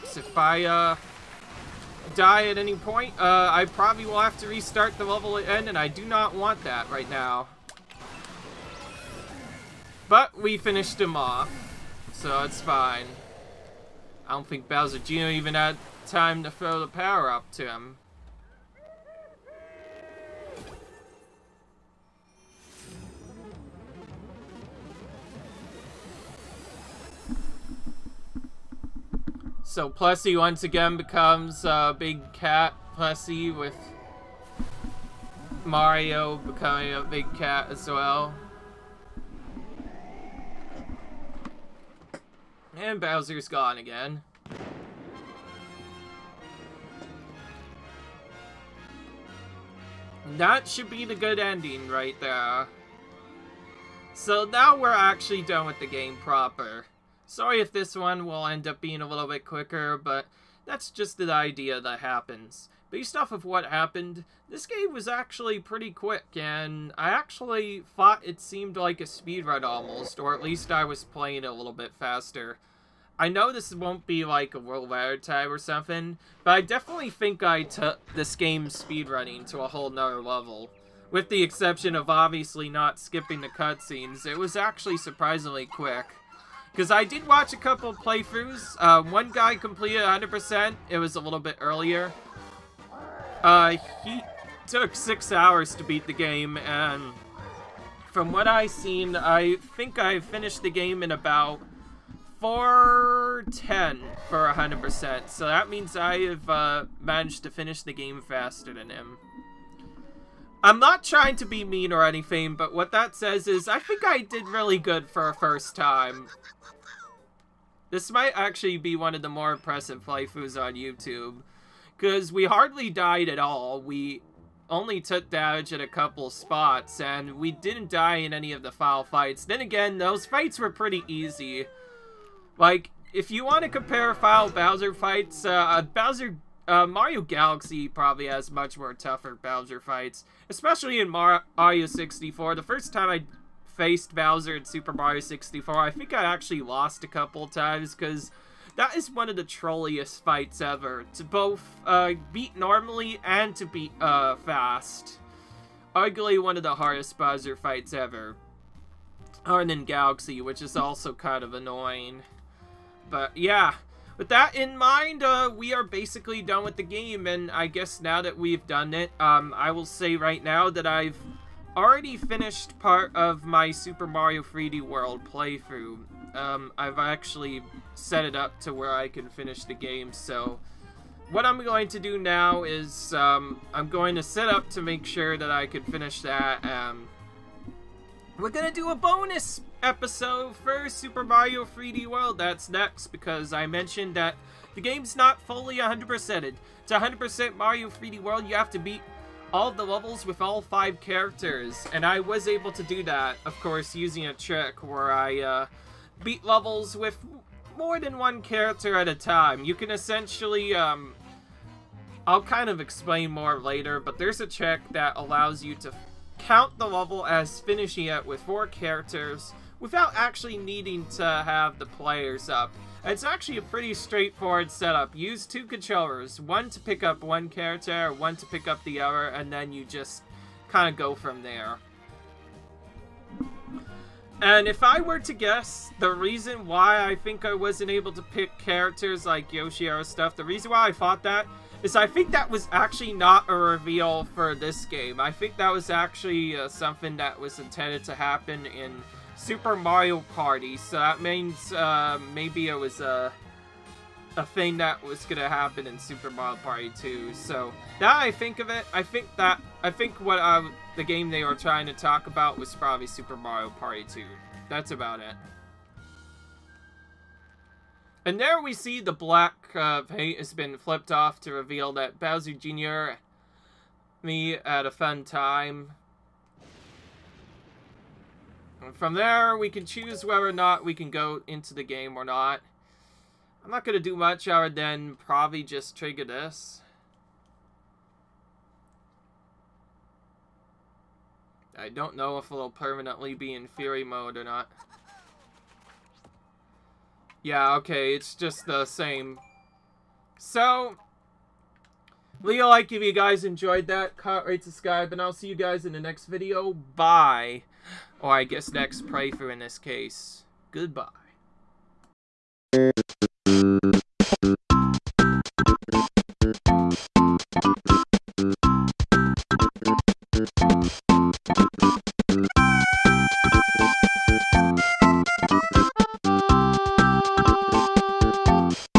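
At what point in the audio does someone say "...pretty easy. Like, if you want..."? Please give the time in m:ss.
2:10.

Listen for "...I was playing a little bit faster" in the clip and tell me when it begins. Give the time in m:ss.
1:10.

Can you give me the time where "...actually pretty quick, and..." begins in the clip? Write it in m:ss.
1:05.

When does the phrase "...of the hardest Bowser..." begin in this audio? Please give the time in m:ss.
2:36.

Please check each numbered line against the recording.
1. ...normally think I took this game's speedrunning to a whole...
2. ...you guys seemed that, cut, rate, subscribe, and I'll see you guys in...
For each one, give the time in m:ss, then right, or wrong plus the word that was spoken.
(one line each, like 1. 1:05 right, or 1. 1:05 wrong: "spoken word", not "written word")
1. 1:16 wrong: "definitely", not "normally"
2. 5:03 wrong: "enjoyed", not "seemed".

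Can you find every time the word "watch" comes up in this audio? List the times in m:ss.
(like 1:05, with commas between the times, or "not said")
1:27.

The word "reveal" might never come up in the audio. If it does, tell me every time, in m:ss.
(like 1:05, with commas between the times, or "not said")
4:03, 4:31.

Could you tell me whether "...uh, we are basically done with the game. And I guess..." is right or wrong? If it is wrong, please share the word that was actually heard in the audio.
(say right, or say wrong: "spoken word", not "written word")
right.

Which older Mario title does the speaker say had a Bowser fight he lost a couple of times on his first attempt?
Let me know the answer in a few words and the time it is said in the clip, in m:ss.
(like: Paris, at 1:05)
Super Mario 64, at 2:24.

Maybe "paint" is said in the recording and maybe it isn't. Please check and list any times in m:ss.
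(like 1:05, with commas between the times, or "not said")
4:30.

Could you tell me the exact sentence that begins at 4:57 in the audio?
Yeah, okay, it's just the same.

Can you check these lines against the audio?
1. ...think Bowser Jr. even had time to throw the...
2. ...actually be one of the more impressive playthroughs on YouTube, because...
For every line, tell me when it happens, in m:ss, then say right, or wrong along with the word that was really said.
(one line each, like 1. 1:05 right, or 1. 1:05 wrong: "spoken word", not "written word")
1. 0:14 right
2. 1:58 right.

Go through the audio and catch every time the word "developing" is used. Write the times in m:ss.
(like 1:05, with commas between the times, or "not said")
not said.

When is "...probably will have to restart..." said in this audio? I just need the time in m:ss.
0:03.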